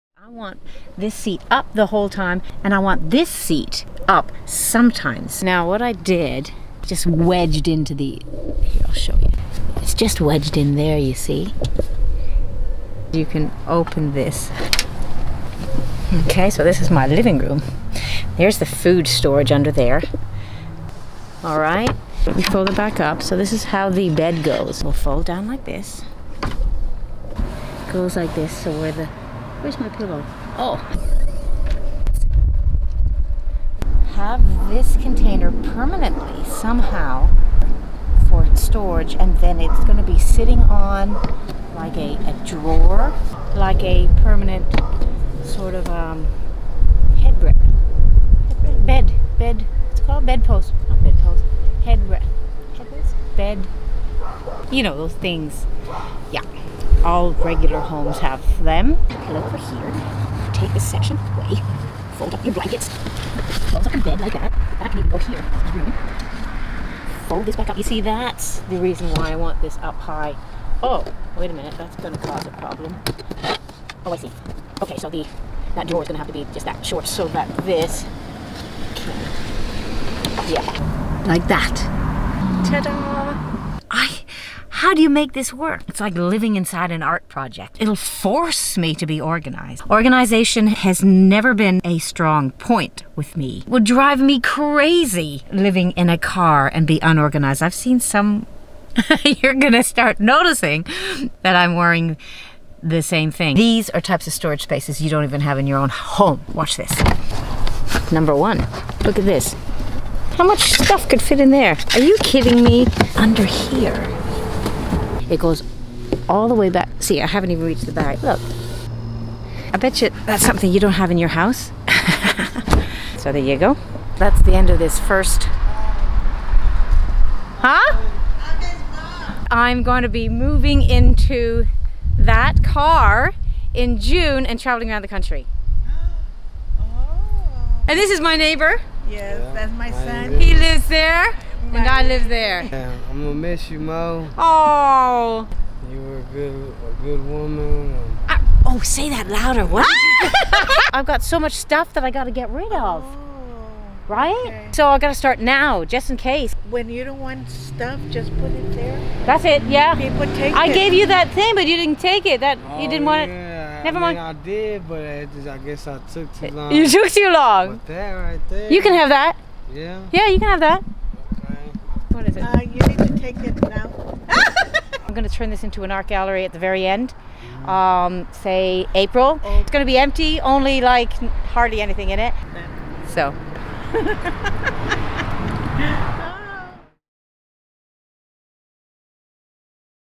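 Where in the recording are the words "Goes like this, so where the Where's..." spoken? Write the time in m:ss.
0:27.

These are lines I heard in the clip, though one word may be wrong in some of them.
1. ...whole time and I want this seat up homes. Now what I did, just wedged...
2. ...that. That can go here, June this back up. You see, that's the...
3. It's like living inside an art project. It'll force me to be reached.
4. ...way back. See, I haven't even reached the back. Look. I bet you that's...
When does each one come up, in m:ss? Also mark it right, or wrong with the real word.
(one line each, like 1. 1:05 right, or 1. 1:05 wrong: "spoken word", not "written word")
1. 0:01 wrong: "sometimes", not "homes"
2. 1:04 wrong: "Fold", not "June"
3. 1:25 wrong: "organized", not "reached"
4. 1:56 right.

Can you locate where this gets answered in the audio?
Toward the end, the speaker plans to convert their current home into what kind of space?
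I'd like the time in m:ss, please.
2:55.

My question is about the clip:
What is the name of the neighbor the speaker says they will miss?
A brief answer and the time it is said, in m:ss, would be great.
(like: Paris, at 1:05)
Mo, at 2:23.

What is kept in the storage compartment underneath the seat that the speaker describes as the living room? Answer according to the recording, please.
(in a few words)
Food storage.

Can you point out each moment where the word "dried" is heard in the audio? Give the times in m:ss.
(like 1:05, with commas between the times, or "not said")
not said.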